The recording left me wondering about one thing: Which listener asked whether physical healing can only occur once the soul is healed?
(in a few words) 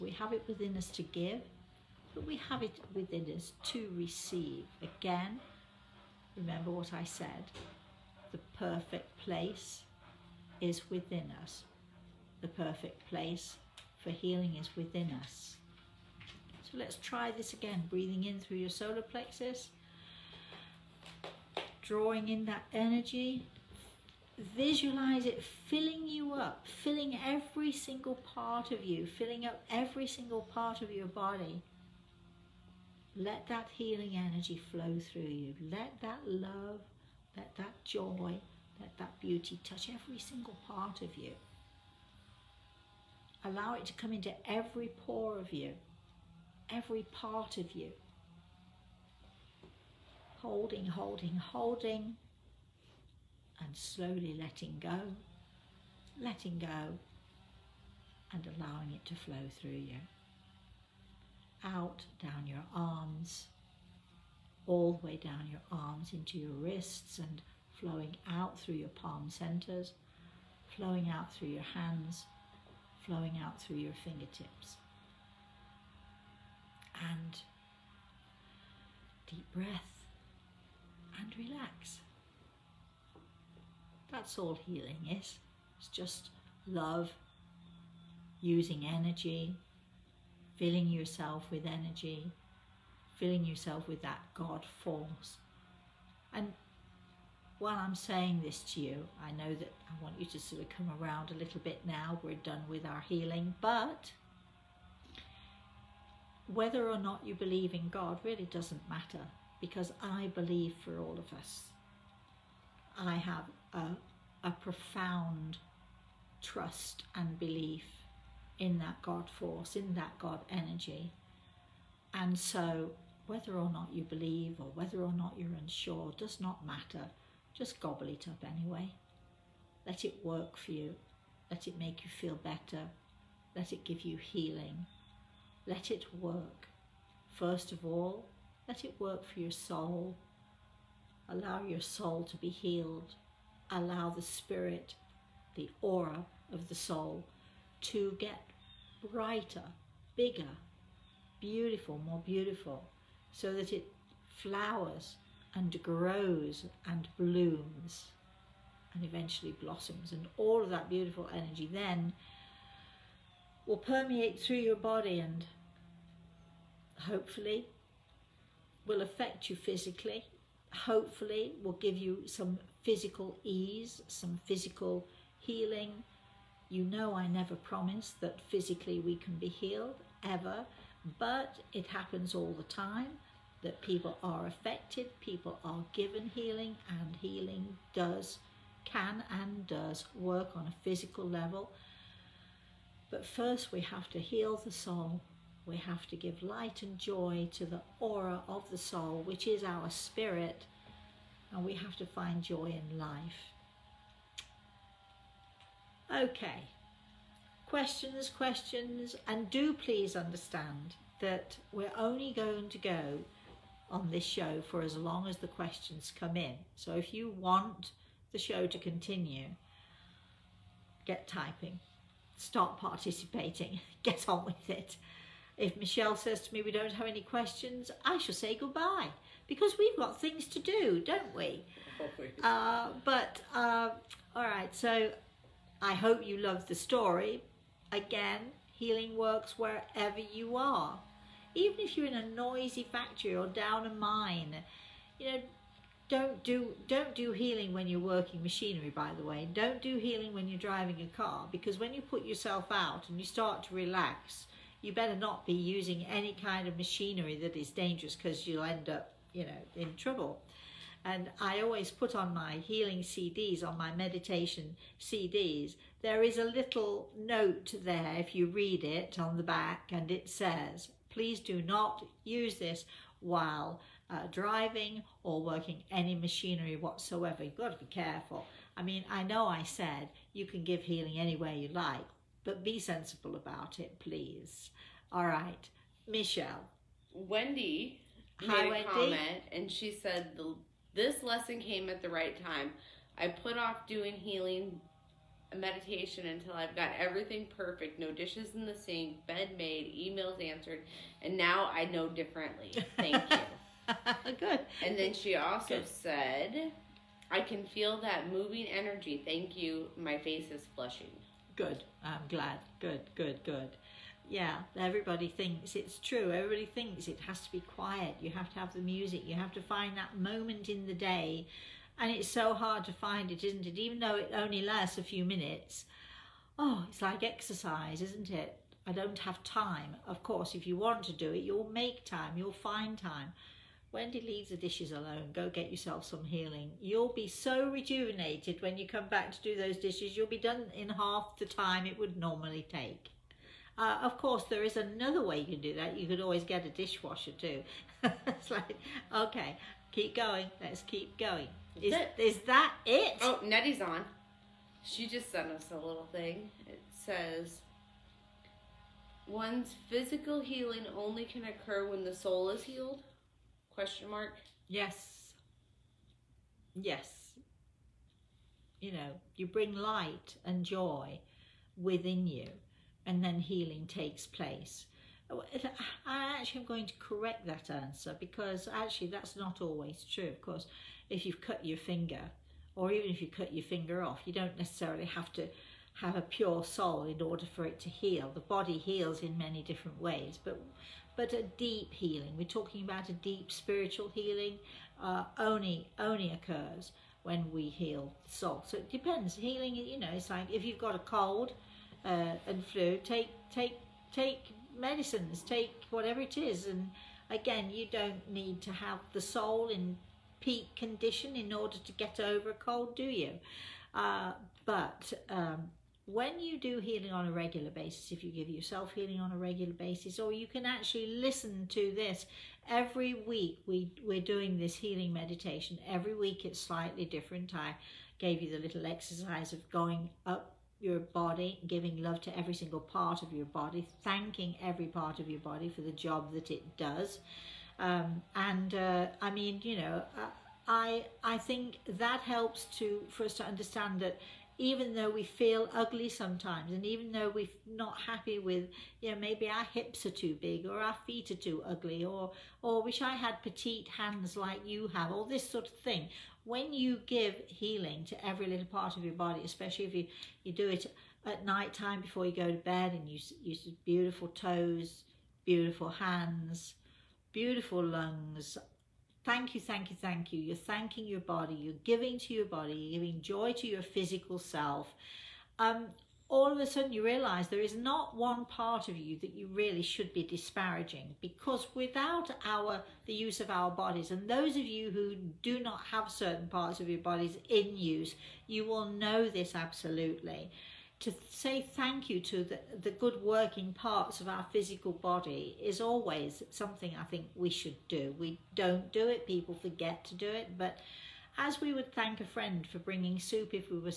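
Nettie.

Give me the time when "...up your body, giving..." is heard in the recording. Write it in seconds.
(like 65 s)
430 s.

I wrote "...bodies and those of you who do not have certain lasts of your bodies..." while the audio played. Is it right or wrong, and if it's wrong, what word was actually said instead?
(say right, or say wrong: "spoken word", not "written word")
wrong: "parts", not "lasts".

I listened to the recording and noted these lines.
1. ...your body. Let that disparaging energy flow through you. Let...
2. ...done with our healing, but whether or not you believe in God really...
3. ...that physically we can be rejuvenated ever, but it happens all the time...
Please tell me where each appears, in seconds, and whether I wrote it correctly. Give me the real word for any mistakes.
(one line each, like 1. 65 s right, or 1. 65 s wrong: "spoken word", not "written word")
1. 30 s wrong: "healing", not "disparaging"
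2. 102 s right
3. 178 s wrong: "healed", not "rejuvenated".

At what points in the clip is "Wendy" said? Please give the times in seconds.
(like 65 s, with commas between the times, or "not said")
287 s, 333 s.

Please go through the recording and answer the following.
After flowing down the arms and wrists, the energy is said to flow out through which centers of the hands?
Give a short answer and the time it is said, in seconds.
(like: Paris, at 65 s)
palm centers, at 68 s.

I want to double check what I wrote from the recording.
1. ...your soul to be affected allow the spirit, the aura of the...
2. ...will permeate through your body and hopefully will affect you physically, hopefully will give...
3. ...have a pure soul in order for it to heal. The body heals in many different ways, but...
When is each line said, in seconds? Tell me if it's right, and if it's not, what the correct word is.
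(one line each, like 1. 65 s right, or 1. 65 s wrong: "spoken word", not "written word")
1. 141 s wrong: "healed", not "affected"
2. 163 s right
3. 385 s right.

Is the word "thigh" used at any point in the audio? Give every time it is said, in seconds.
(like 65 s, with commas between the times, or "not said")
not said.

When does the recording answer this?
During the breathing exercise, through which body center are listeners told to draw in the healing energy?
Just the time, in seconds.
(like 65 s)
18 s.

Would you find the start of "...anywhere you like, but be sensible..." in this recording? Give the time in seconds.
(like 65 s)
281 s.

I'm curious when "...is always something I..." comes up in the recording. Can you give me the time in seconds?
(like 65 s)
495 s.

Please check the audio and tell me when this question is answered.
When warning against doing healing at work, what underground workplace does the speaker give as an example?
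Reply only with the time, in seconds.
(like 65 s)
243 s.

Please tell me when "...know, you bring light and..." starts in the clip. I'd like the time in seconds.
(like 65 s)
368 s.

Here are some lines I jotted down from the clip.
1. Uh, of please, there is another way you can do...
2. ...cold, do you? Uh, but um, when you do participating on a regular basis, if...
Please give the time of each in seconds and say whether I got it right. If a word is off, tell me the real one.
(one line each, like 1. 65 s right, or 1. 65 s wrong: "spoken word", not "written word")
1. 343 s wrong: "course", not "please"
2. 412 s wrong: "healing", not "participating".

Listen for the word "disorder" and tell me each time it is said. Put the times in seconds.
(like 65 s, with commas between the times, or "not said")
not said.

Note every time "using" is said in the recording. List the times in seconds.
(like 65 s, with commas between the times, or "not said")
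88 s, 255 s.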